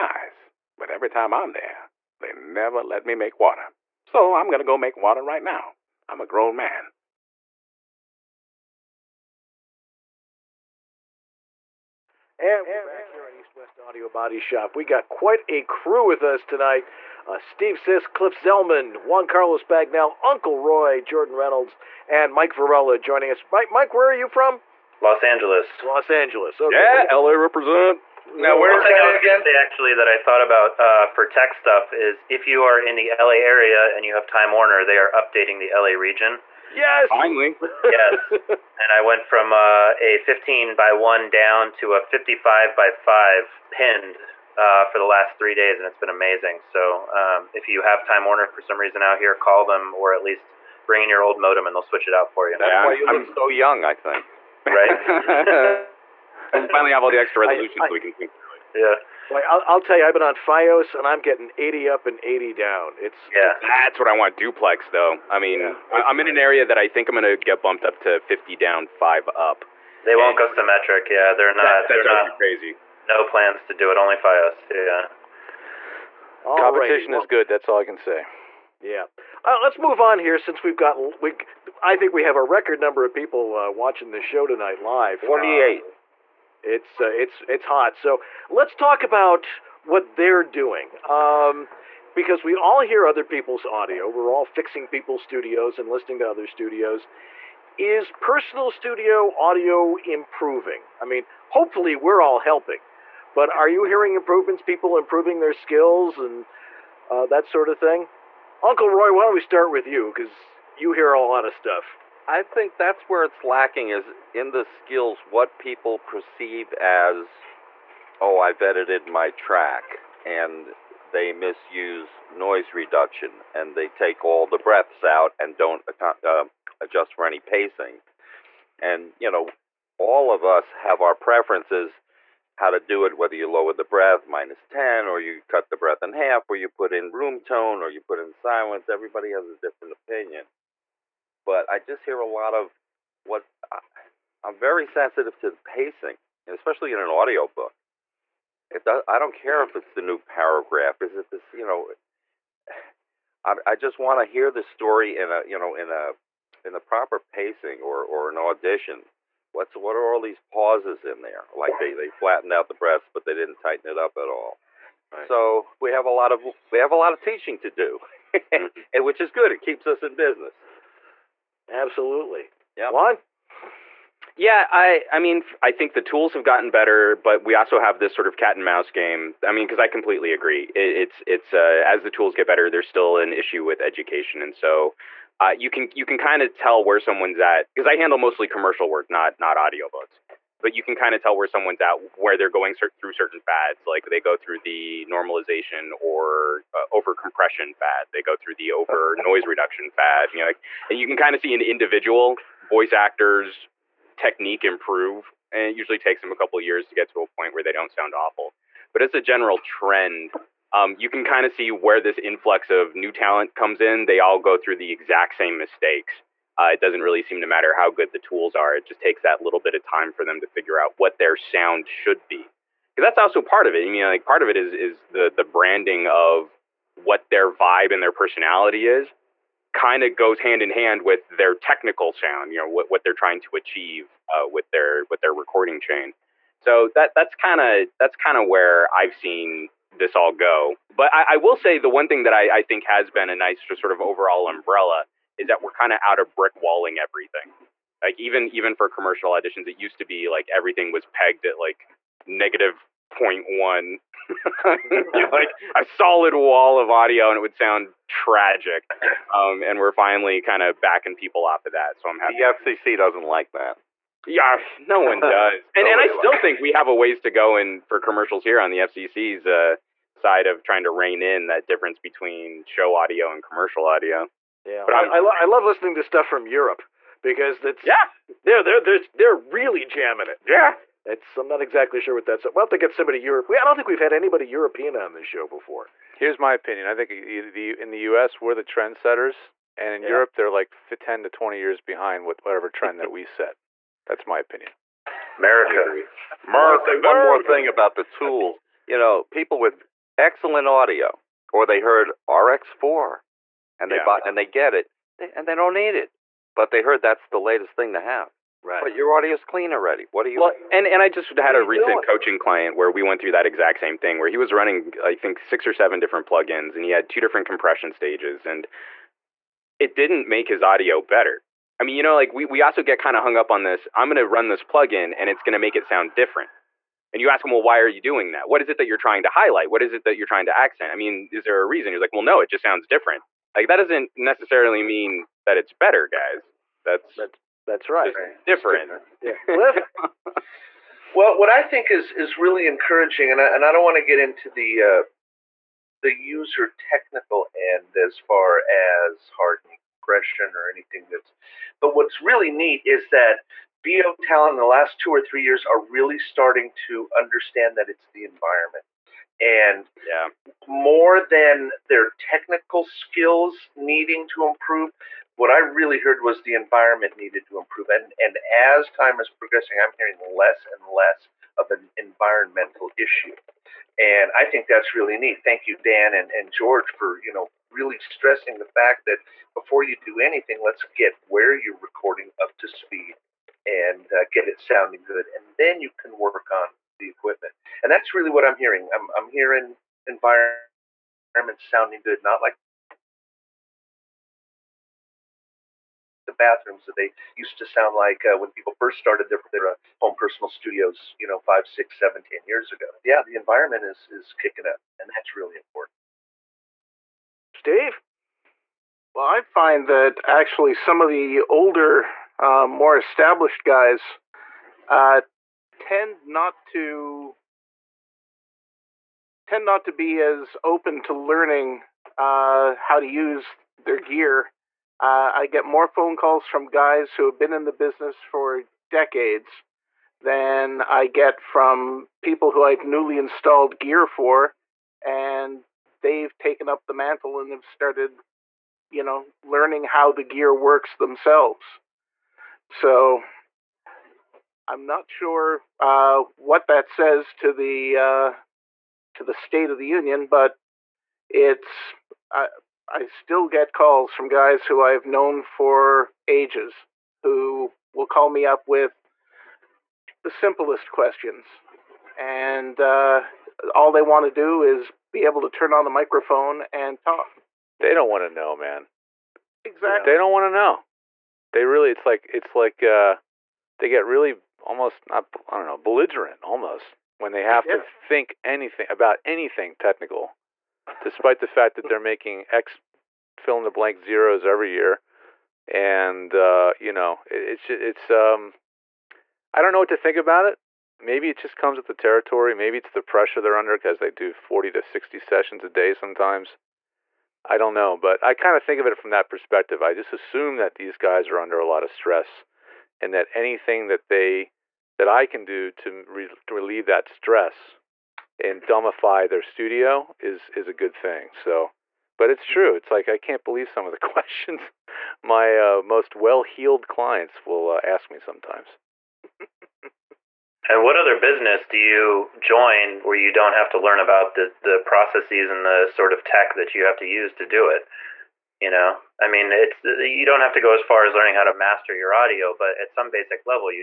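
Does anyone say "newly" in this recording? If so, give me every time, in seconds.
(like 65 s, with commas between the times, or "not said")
432 s.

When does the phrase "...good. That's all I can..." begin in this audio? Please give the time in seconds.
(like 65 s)
77 s.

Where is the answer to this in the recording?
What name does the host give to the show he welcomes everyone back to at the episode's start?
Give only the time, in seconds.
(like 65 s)
13 s.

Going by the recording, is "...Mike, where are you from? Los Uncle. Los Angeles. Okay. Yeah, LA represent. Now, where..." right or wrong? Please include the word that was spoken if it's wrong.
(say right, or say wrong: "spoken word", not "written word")
wrong: "Angeles", not "Uncle".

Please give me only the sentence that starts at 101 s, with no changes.
I mean, hopefully we're all helping, but are you hearing improvements, people improving their skills and uh, that sort of thing?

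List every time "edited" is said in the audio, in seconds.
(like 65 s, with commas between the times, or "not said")
118 s.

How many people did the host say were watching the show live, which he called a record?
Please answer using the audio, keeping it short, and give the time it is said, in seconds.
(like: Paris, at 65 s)
48, at 85 s.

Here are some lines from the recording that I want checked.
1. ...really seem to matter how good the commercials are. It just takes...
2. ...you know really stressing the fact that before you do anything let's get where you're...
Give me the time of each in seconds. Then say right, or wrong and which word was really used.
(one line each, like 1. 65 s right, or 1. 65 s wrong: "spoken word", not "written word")
1. 217 s wrong: "tools", not "commercials"
2. 377 s right.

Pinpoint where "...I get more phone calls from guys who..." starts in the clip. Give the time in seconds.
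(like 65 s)
425 s.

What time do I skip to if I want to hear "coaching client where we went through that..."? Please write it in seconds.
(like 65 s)
312 s.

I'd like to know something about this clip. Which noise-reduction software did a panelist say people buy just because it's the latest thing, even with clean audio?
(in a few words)
RX4.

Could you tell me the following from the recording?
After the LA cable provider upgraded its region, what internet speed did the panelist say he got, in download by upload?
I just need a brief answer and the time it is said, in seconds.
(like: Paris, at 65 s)
55 by 5, at 42 s.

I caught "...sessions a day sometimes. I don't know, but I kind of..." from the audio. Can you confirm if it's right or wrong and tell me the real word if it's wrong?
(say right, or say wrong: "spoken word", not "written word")
right.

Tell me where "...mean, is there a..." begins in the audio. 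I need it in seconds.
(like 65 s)
330 s.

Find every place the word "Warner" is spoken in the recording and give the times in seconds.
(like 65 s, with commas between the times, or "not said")
34 s, 48 s.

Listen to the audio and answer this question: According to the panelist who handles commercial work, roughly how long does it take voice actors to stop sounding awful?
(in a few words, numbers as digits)
a couple years.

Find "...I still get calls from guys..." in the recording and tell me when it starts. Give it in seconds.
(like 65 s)
452 s.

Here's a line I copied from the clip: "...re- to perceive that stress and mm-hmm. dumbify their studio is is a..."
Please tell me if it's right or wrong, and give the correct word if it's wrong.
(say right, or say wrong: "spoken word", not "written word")
wrong: "relieve", not "perceive".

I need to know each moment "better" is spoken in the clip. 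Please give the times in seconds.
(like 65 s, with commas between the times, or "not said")
176 s, 182 s, 321 s, 335 s.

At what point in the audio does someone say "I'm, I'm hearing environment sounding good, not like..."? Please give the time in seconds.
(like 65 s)
388 s.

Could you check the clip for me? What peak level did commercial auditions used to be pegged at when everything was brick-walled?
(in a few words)
-0.1.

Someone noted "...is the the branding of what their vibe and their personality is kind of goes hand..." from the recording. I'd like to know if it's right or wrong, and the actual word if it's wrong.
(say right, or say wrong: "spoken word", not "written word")
right.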